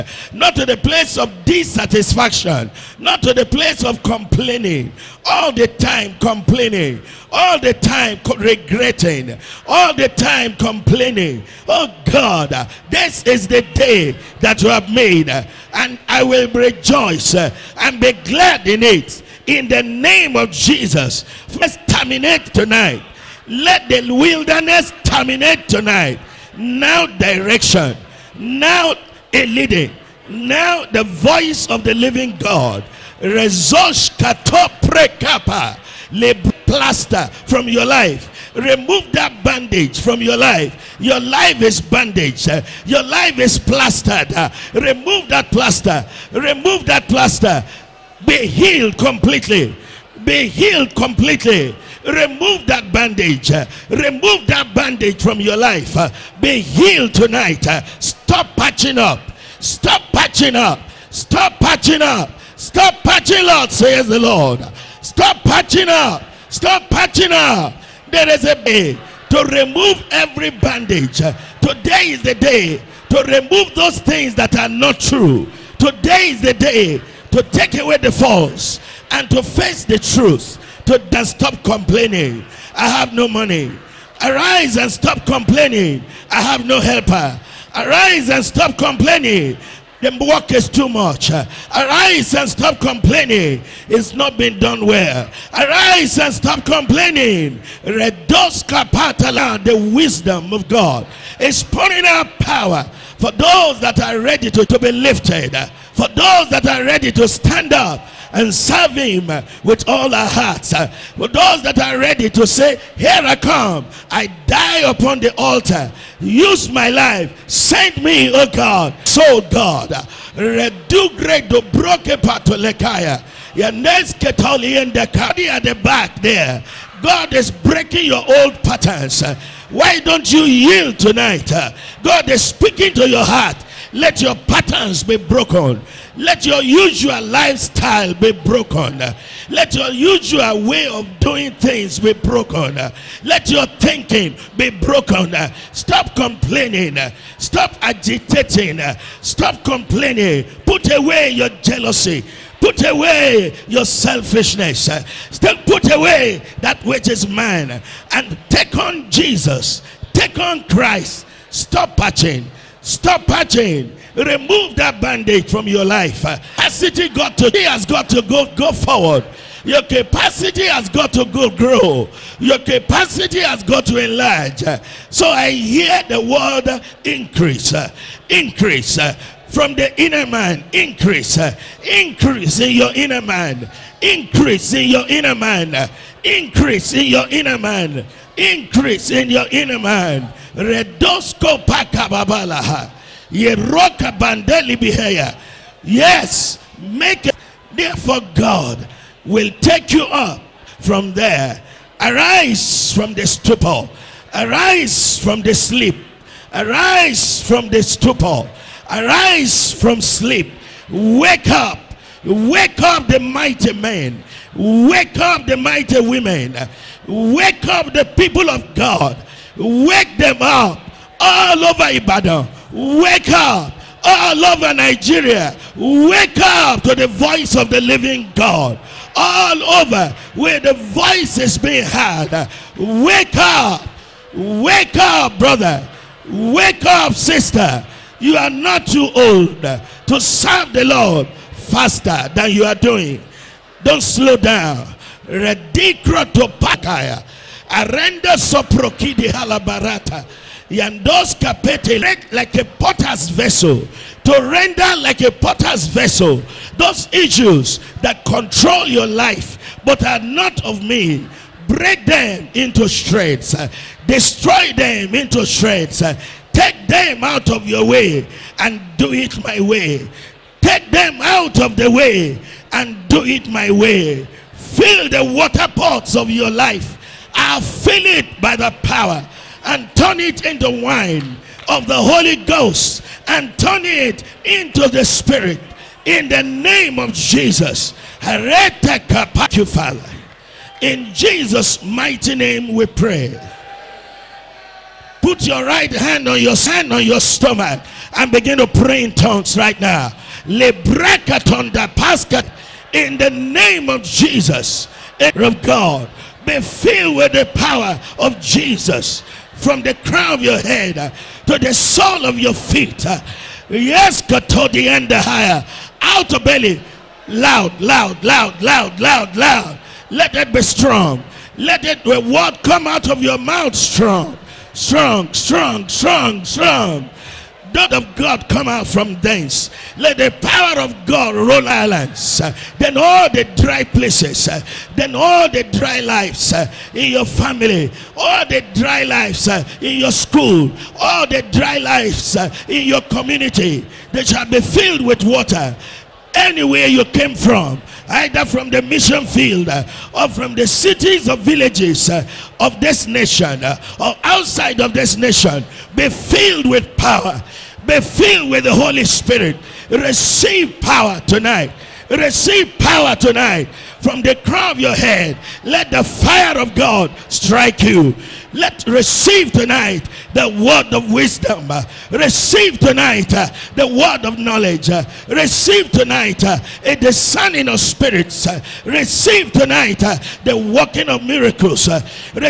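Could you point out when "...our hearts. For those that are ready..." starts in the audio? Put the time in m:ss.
1:50.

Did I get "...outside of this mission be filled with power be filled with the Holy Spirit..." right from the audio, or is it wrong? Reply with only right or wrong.
wrong.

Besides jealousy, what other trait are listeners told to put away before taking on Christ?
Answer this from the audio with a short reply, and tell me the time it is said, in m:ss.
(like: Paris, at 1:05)
Selfishness, at 2:33.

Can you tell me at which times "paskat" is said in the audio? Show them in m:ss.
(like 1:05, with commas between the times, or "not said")
5:01.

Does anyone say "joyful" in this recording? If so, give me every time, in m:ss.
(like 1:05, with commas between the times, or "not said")
not said.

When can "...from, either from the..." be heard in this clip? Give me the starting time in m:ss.
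5:47.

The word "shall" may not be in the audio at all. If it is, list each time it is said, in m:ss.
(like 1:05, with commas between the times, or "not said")
5:44.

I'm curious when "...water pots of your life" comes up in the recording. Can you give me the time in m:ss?
4:35.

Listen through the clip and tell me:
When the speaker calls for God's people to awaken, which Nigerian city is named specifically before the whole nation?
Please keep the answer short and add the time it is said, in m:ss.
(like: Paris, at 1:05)
Ibadan, at 3:41.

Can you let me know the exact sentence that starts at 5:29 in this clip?
Let the power of God roll islands.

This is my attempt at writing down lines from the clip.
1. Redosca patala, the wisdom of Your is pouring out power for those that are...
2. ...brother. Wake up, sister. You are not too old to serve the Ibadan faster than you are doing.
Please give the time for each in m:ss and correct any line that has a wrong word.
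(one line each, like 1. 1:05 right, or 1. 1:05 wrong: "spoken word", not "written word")
1. 1:37 wrong: "God", not "Your"
2. 3:55 wrong: "Lord", not "Ibadan".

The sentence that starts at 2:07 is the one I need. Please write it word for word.
God is breaking your old patterns.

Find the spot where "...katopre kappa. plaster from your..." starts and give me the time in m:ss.
0:34.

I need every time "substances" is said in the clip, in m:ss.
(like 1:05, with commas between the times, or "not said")
not said.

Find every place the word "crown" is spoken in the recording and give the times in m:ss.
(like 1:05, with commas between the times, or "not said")
5:10, 6:04.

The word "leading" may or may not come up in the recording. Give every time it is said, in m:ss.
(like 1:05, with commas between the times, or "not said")
0:29.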